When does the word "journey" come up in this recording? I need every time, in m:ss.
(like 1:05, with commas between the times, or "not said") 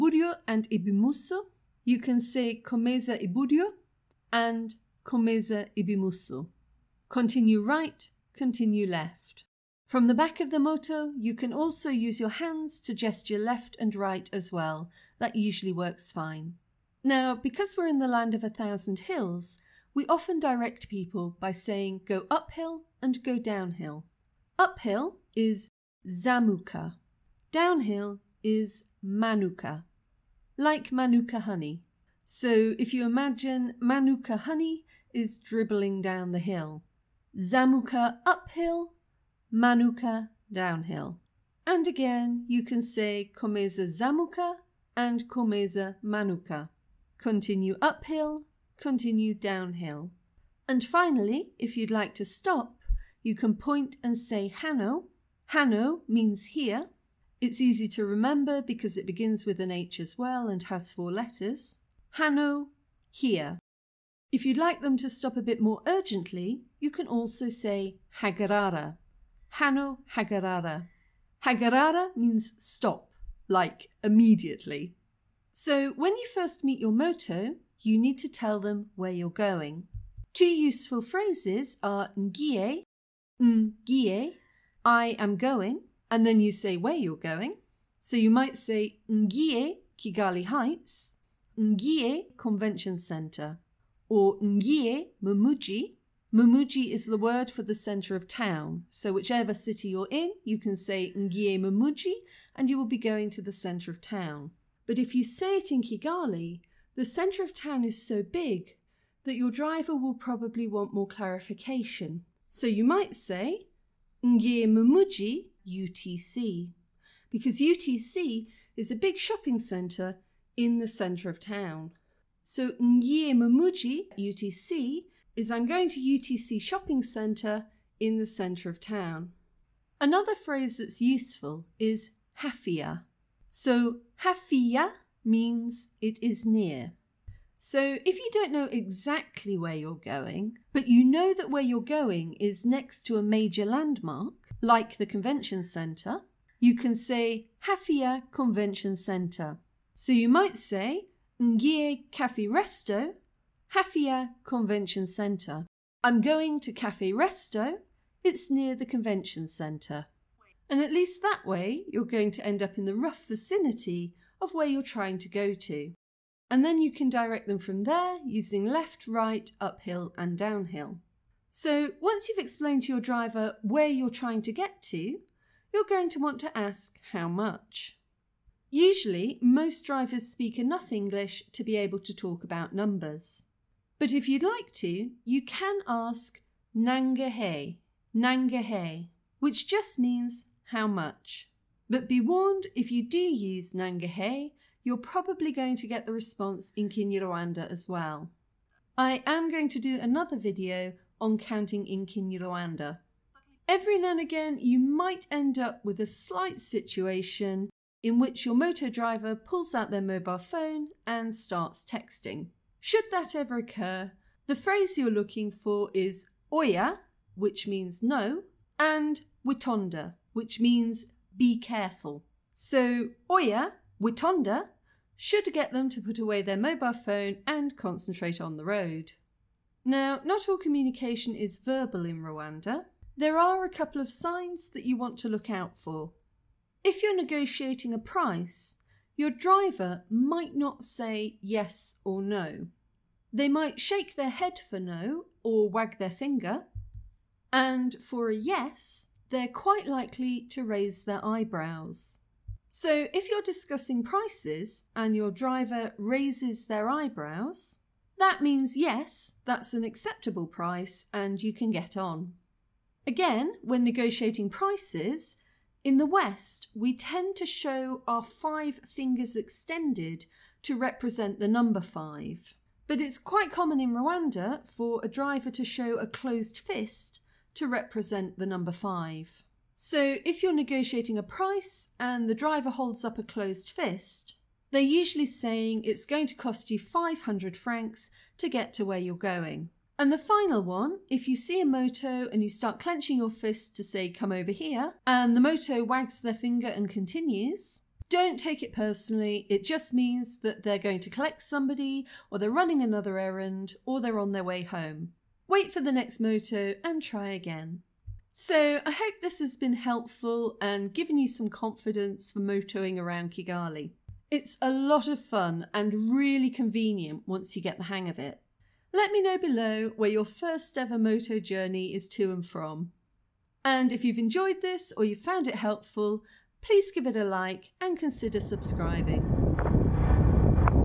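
5:21.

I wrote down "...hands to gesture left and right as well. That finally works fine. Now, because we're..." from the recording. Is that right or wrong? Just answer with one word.
wrong.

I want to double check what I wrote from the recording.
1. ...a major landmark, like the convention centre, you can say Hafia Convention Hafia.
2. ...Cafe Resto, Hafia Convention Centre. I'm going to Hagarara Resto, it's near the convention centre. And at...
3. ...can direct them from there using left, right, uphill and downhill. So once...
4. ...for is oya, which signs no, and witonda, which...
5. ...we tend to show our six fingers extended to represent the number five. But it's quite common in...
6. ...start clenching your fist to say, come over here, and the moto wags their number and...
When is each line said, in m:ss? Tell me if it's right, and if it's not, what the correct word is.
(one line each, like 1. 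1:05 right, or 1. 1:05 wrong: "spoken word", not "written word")
1. 2:23 wrong: "Centre", not "Hafia"
2. 2:32 wrong: "Cafe", not "Hagarara"
3. 2:46 right
4. 3:35 wrong: "means", not "signs"
5. 4:26 wrong: "five", not "six"
6. 4:52 wrong: "finger", not "number".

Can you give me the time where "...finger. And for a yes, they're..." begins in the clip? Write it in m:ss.
4:06.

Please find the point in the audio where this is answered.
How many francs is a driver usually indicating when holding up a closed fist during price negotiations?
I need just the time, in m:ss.
4:46.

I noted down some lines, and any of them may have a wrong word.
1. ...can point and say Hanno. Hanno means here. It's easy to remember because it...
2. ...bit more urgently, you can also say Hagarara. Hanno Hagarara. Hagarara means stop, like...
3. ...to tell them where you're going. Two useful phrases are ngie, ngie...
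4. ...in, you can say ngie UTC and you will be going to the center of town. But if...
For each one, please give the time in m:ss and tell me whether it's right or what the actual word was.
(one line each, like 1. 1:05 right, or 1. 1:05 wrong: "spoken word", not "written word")
1. 0:53 right
2. 1:05 right
3. 1:18 right
4. 1:40 wrong: "Mumuji", not "UTC".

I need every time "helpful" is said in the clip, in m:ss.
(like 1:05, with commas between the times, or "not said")
5:09, 5:25.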